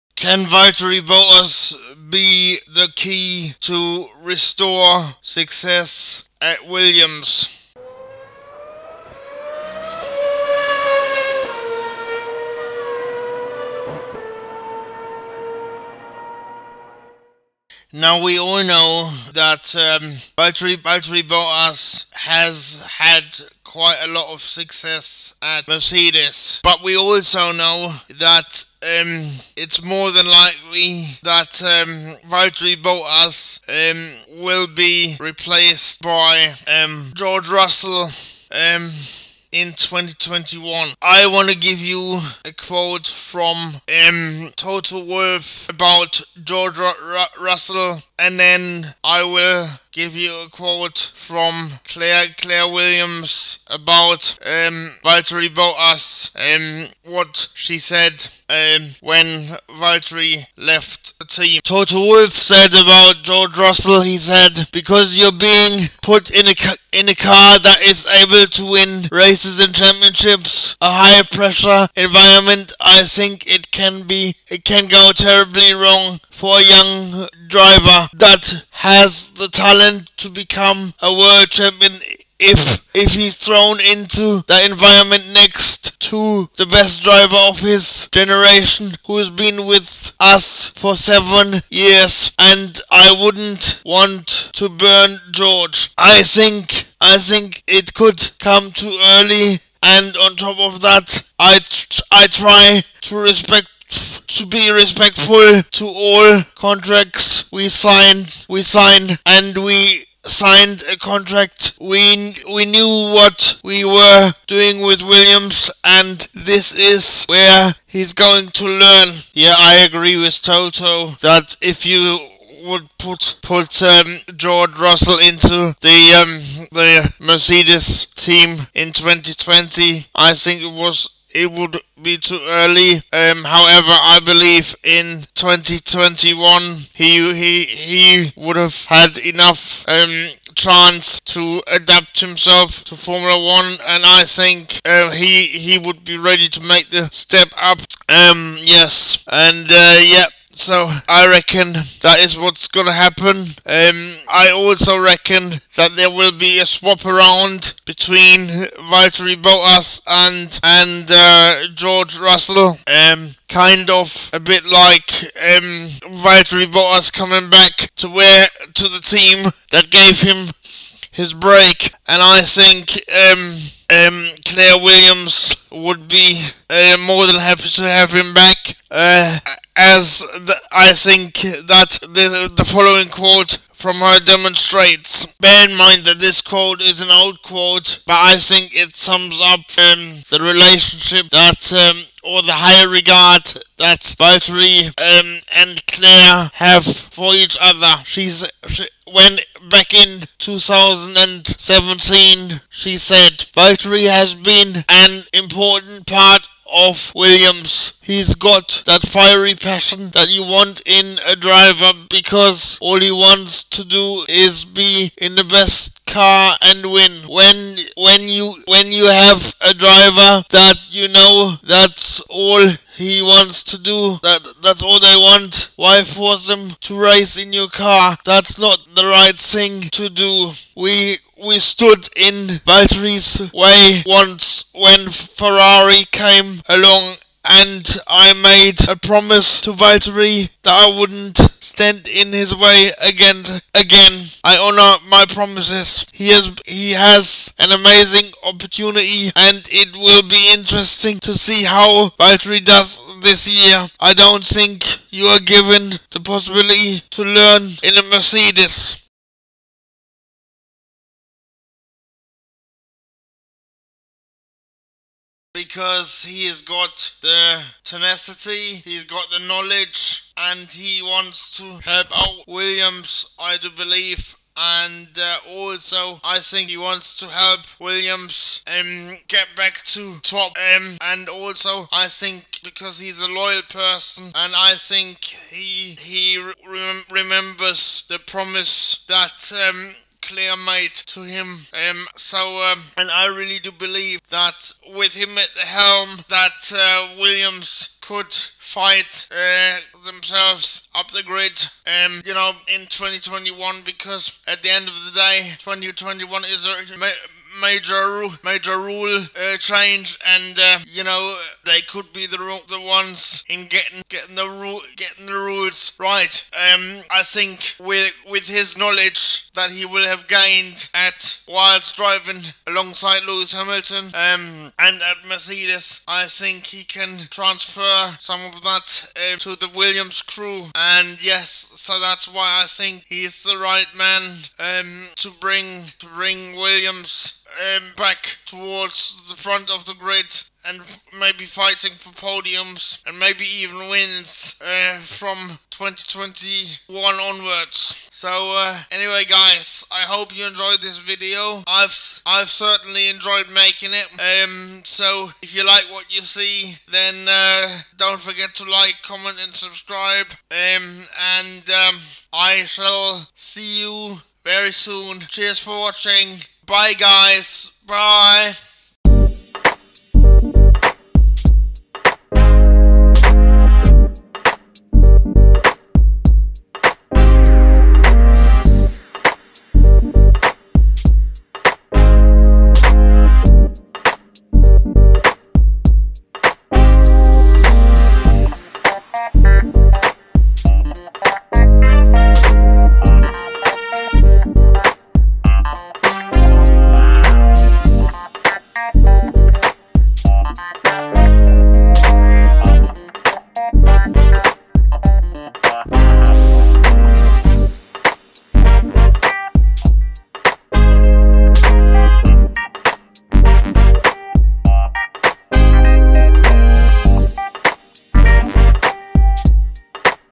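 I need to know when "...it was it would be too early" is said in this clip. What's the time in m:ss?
2:10.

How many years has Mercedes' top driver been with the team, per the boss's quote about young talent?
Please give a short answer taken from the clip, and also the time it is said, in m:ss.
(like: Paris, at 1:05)
seven, at 1:30.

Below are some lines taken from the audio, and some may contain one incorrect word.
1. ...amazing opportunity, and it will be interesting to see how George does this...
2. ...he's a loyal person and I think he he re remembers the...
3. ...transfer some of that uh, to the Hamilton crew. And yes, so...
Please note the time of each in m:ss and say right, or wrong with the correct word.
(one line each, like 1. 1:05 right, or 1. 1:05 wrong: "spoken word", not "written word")
1. 4:07 wrong: "Valtteri", not "George"
2. 4:42 right
3. 5:27 wrong: "Williams", not "Hamilton".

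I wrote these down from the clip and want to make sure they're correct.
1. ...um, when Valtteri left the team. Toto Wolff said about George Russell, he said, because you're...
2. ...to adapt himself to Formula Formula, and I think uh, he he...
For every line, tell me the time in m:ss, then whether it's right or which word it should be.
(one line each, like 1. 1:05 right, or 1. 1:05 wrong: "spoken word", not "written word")
1. 0:58 right
2. 2:21 wrong: "One", not "Formula".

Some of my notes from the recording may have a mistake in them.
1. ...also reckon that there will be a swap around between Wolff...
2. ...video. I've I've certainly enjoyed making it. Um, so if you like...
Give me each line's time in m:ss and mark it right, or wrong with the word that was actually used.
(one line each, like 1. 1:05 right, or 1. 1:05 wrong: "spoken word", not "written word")
1. 2:34 wrong: "Valtteri", not "Wolff"
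2. 5:50 right.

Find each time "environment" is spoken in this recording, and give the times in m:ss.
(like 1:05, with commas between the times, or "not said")
1:11, 1:24.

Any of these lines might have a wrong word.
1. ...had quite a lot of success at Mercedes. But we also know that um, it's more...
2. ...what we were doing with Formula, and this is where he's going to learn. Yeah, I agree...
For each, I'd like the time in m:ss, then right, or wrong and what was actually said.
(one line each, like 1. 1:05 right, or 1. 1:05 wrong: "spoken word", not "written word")
1. 0:22 right
2. 1:52 wrong: "Williams", not "Formula".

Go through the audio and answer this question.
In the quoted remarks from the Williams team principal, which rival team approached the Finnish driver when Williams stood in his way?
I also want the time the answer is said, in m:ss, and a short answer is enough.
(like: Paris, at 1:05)
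Ferrari, at 3:55.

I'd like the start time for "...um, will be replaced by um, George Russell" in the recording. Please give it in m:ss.
0:33.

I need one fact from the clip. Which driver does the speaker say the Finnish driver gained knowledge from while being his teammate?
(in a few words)
Lewis Hamilton.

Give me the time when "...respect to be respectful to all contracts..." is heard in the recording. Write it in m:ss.
1:43.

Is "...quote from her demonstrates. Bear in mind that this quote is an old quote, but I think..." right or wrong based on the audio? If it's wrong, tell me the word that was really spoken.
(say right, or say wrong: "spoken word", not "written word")
right.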